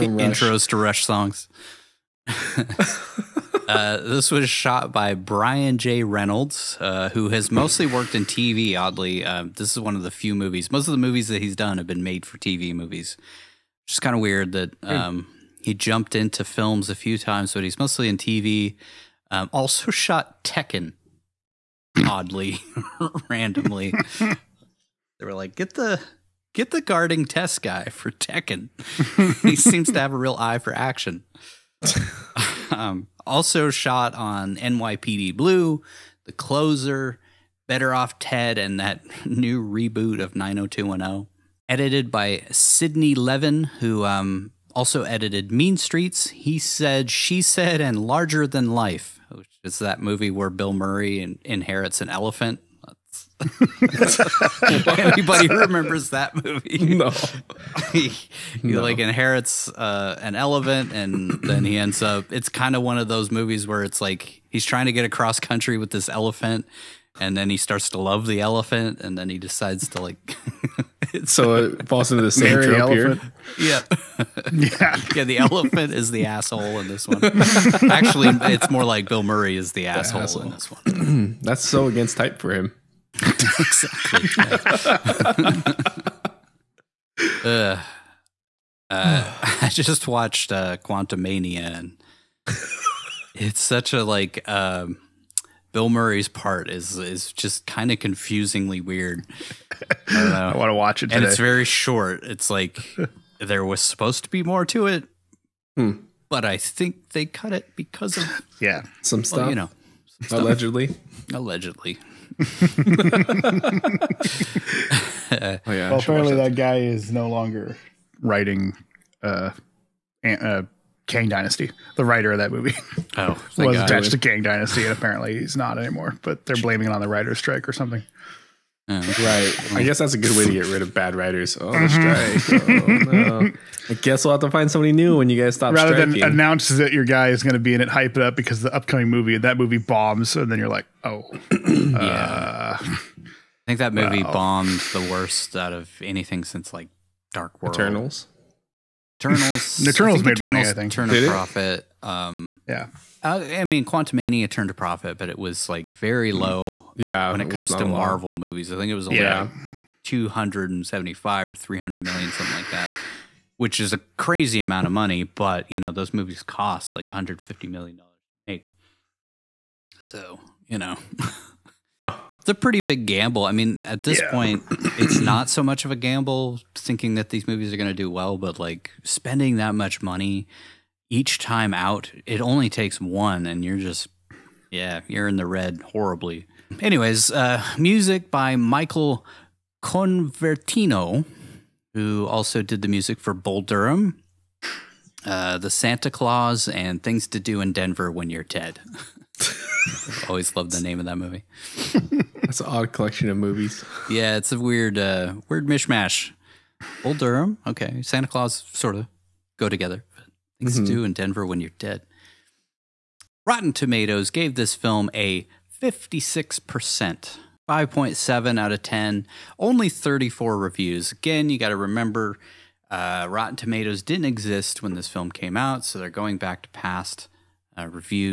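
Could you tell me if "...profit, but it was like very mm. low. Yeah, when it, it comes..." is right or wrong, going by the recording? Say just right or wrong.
right.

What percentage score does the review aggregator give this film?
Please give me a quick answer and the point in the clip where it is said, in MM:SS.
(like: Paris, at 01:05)
56%, at 03:35.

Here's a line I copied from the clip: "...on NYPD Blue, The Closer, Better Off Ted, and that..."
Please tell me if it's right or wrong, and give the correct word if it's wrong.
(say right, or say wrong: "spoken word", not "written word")
right.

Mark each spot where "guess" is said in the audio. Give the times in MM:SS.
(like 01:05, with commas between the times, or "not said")
02:09, 02:13.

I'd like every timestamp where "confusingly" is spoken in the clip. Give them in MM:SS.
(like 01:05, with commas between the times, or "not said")
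01:37.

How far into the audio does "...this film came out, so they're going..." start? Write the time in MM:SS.
03:44.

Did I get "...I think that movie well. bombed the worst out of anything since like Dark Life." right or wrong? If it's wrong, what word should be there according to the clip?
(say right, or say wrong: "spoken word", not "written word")
wrong: "World", not "Life".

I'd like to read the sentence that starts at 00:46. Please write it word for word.
He said, She Said, and Larger Than Life, which is that movie where Bill Murray in inherits an elephant.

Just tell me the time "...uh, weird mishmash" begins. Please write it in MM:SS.
03:24.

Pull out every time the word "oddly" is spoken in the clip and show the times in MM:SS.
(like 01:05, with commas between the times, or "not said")
00:08, 00:22.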